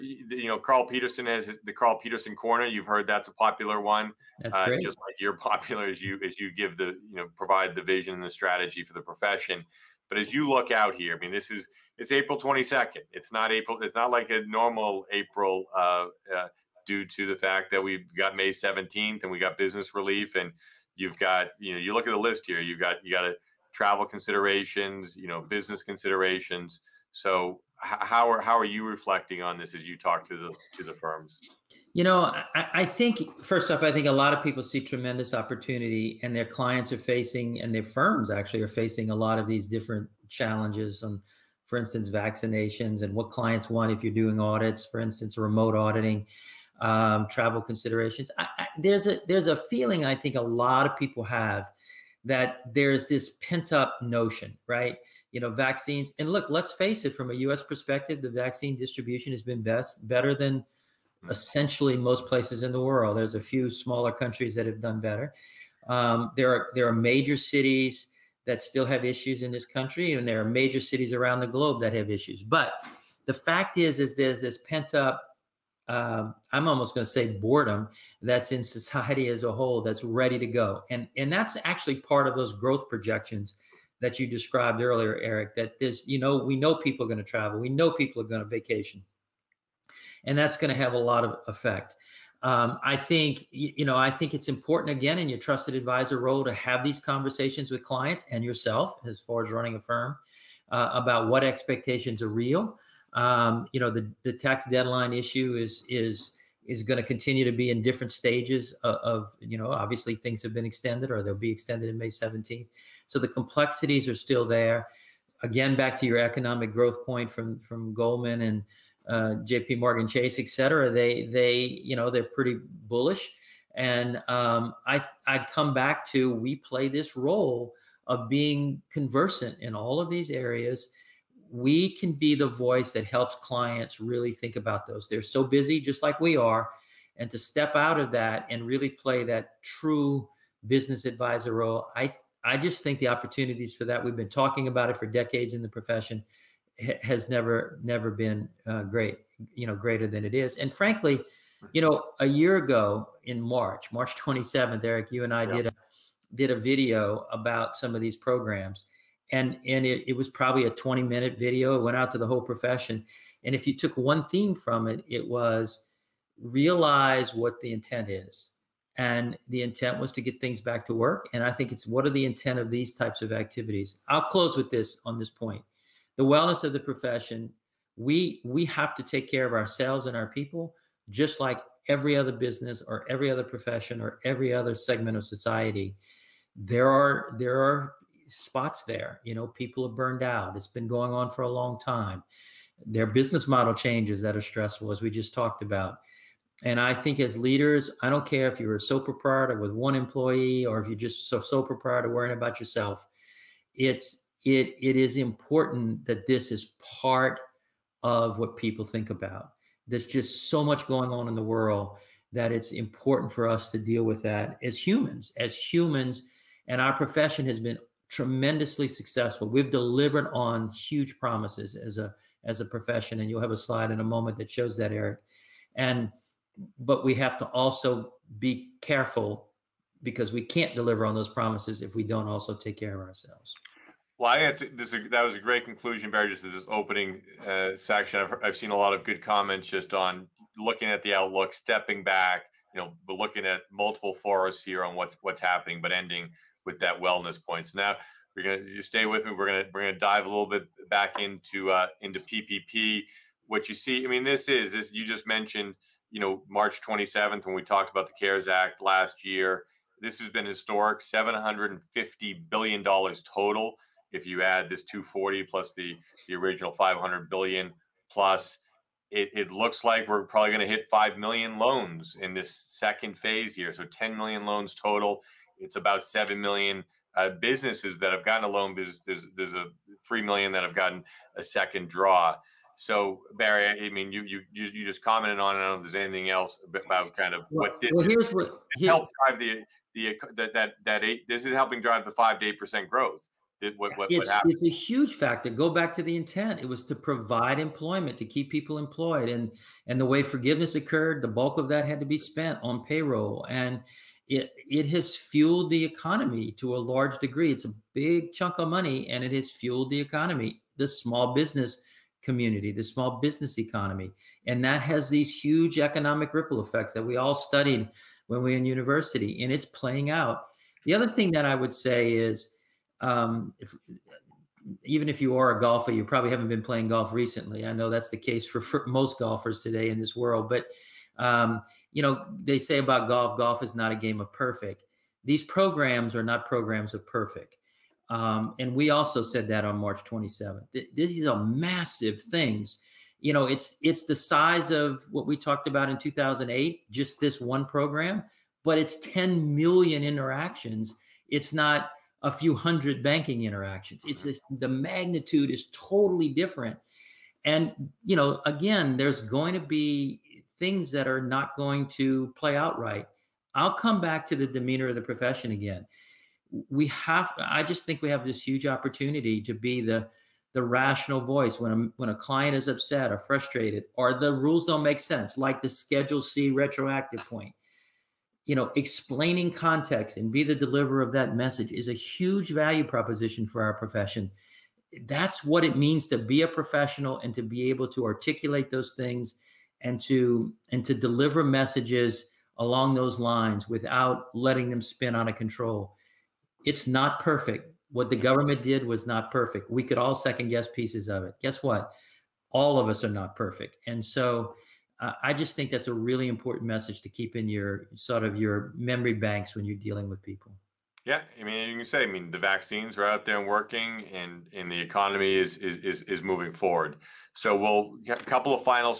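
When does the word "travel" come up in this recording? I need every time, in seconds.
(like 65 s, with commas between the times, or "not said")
23 s, 47 s, 87 s.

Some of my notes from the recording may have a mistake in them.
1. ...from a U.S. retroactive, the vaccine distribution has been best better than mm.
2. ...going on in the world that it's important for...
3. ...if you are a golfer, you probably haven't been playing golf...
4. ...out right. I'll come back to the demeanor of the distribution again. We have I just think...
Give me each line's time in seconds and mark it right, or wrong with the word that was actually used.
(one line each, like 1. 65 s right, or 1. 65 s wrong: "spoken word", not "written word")
1. 57 s wrong: "perspective", not "retroactive"
2. 210 s right
3. 325 s right
4. 362 s wrong: "profession", not "distribution".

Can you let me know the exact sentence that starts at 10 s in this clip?
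But as you look out here, I mean, this is it's April 22nd.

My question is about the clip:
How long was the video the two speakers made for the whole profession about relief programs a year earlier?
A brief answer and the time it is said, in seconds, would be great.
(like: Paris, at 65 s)
20 minutes, at 160 s.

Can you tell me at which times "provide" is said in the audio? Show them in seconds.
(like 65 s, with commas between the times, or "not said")
7 s, 296 s.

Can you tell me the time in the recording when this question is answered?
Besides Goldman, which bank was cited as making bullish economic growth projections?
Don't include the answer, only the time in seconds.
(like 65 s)
119 s.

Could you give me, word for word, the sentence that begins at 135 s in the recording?
They're so busy, just like we are.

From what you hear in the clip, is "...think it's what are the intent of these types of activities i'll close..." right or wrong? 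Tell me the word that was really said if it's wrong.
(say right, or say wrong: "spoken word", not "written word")
right.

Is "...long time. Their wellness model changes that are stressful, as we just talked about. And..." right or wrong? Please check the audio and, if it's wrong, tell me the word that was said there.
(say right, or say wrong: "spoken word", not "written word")
wrong: "business", not "wellness".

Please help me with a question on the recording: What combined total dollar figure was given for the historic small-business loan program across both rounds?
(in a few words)
750 billion dollars.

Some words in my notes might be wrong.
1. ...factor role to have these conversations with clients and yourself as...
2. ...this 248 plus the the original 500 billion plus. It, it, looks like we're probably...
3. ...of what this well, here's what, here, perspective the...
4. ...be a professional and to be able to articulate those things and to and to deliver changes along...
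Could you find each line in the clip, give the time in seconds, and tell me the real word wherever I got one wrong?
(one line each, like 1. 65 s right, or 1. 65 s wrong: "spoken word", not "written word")
1. 95 s wrong: "advisor", not "factor"
2. 264 s wrong: "240", not "248"
3. 287 s wrong: "drive", not "perspective"
4. 386 s wrong: "messages", not "changes".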